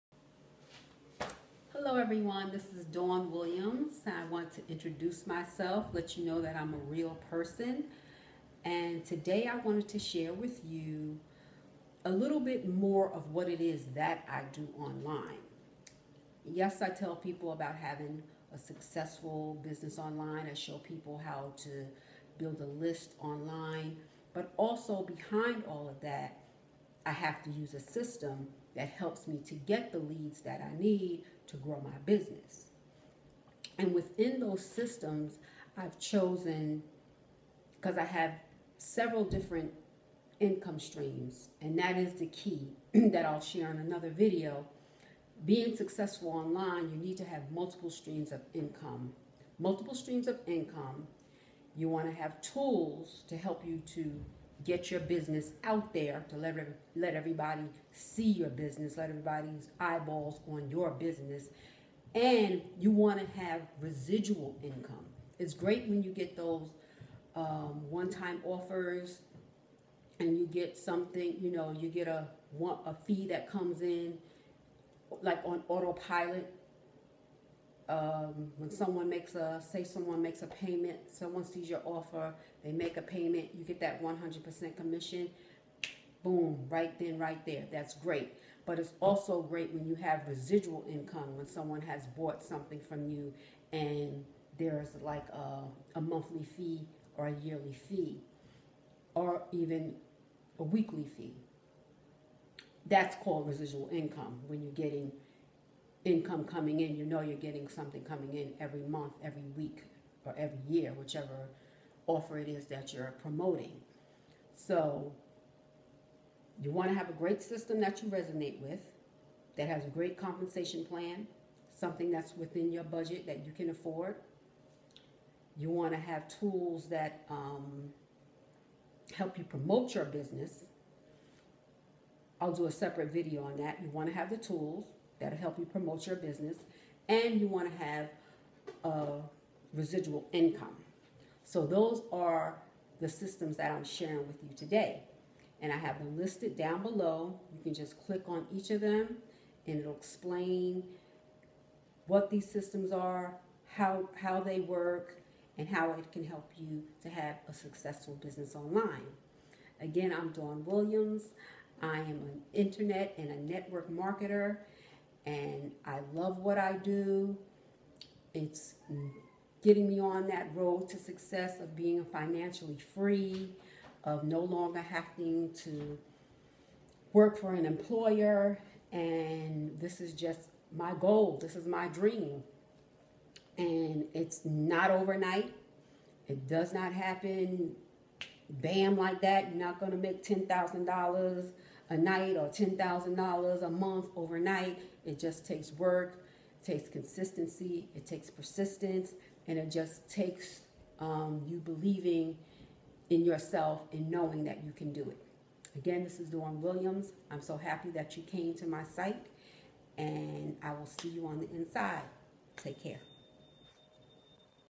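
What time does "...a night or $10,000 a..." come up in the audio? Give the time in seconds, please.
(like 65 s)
191 s.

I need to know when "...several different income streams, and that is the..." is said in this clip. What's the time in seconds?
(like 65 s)
38 s.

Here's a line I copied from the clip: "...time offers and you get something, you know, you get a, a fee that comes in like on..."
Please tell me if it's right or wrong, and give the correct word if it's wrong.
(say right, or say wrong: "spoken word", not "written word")
right.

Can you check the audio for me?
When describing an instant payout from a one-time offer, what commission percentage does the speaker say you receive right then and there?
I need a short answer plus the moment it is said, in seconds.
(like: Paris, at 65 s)
100%, at 84 s.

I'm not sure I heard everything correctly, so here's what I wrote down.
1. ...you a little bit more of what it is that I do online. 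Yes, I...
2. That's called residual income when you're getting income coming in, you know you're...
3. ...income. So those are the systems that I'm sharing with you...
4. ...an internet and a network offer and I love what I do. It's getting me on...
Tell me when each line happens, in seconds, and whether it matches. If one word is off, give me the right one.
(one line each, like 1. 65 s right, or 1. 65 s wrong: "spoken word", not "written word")
1. 10 s right
2. 102 s right
3. 140 s right
4. 162 s wrong: "marketer", not "offer".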